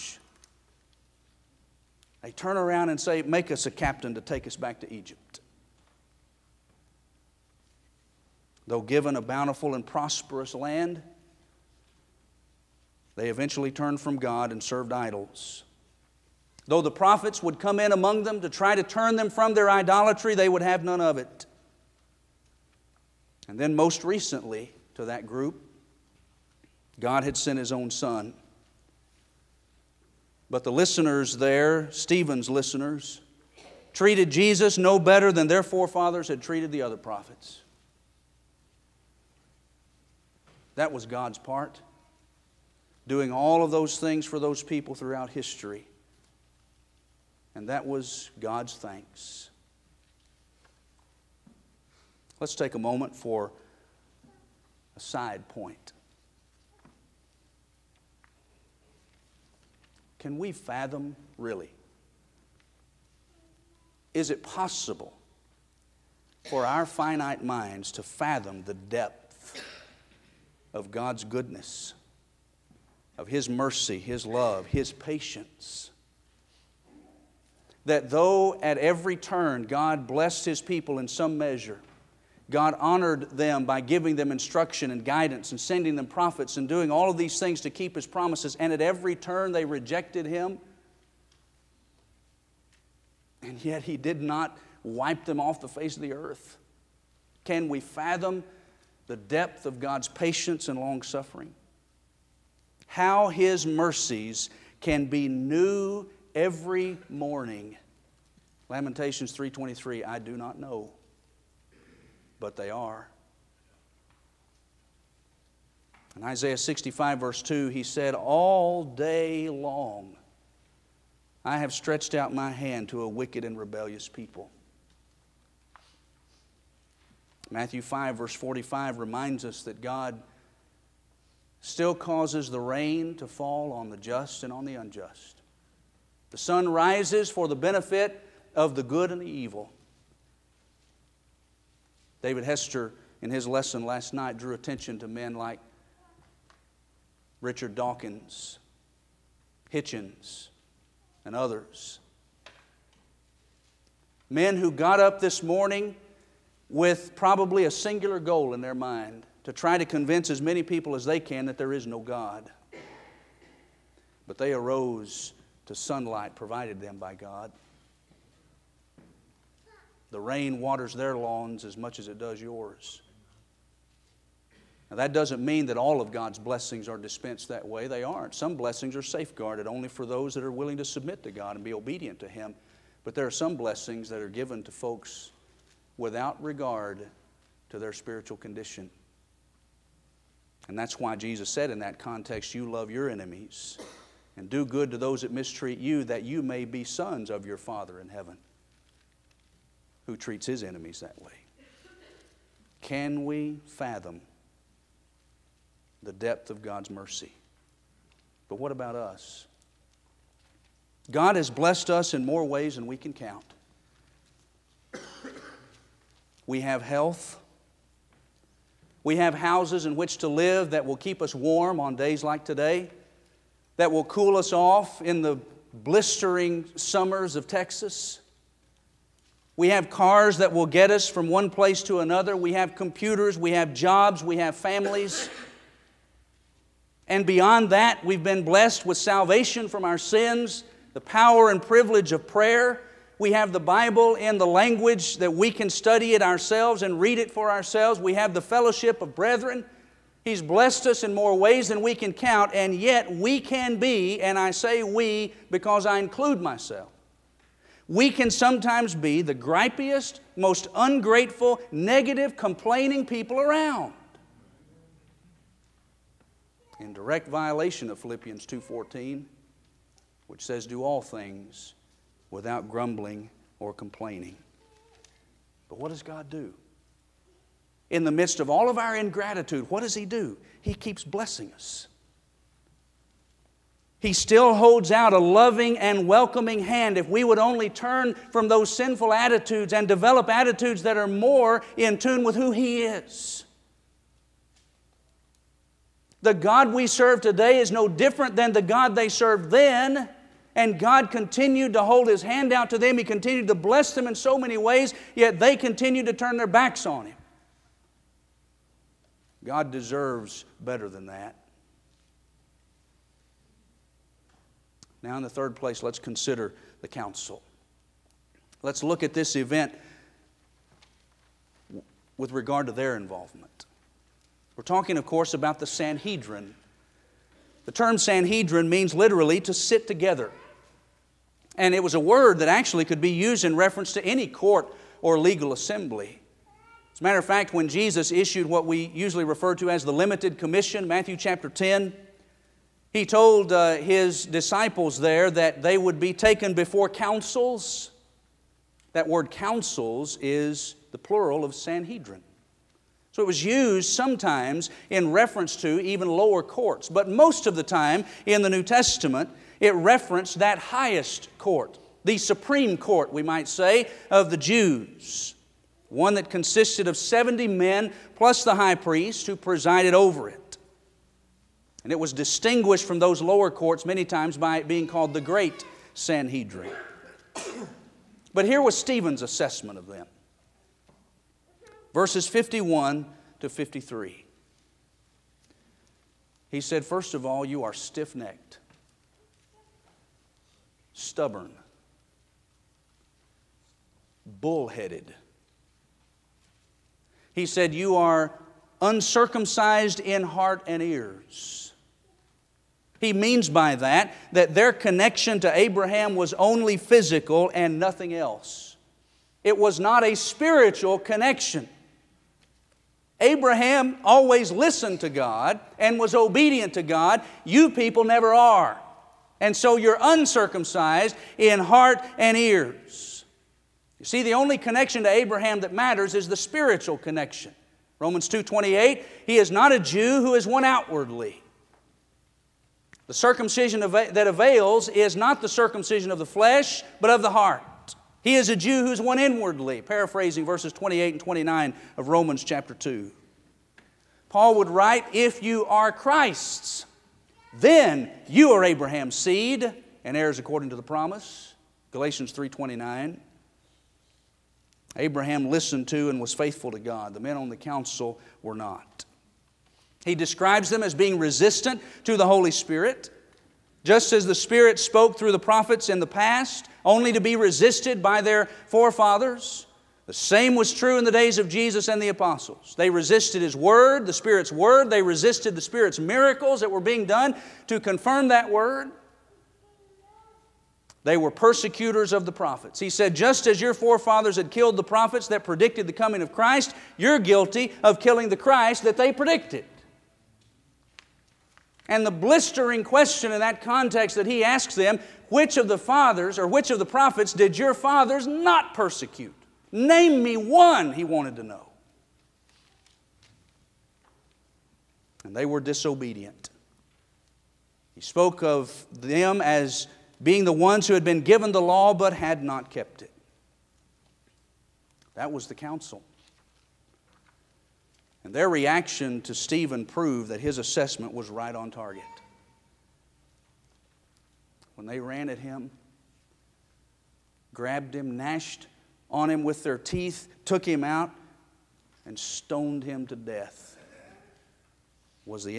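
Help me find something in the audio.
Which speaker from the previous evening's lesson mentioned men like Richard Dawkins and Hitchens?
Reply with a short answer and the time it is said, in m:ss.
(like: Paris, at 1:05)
David Hester, at 2:22.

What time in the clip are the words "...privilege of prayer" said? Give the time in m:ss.
4:01.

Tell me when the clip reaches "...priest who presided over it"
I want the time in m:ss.
6:08.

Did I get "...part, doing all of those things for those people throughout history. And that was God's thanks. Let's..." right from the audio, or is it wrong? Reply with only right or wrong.
right.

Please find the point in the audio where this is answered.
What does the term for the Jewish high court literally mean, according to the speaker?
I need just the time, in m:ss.
5:29.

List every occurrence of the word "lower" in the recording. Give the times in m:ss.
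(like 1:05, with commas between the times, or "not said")
5:56, 6:13.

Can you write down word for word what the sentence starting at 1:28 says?
And at every turn, they rejected him.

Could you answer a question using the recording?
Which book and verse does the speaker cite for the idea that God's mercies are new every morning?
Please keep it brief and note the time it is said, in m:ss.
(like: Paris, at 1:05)
Lamentations 3:23, at 1:48.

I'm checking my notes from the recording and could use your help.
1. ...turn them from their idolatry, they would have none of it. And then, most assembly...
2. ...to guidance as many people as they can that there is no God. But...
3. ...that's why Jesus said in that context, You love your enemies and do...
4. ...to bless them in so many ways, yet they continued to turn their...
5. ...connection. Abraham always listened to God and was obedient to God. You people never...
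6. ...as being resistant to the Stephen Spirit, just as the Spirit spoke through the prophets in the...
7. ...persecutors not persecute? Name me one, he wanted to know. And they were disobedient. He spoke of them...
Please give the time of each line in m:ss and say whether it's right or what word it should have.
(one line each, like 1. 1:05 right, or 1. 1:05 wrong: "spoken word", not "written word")
1. 0:18 wrong: "recently", not "assembly"
2. 2:39 wrong: "convince", not "guidance"
3. 3:10 right
4. 5:03 right
5. 6:50 right
6. 7:40 wrong: "Holy", not "Stephen"
7. 8:17 wrong: "fathers", not "persecutors".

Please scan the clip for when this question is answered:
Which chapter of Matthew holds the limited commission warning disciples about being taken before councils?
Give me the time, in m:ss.
5:40.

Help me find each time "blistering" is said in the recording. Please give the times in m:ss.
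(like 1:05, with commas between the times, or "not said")
3:45, 8:12.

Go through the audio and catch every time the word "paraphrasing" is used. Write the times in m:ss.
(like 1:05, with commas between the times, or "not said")
7:19.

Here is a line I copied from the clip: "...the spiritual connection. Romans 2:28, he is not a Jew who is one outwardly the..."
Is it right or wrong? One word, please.
right.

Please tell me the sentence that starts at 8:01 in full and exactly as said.
They were persecutors of the prophets.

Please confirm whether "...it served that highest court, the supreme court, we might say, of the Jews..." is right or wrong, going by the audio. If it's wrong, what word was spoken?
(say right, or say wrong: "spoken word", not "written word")
wrong: "referenced", not "served".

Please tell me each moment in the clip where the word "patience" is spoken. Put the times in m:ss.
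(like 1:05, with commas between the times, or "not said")
1:14, 1:40.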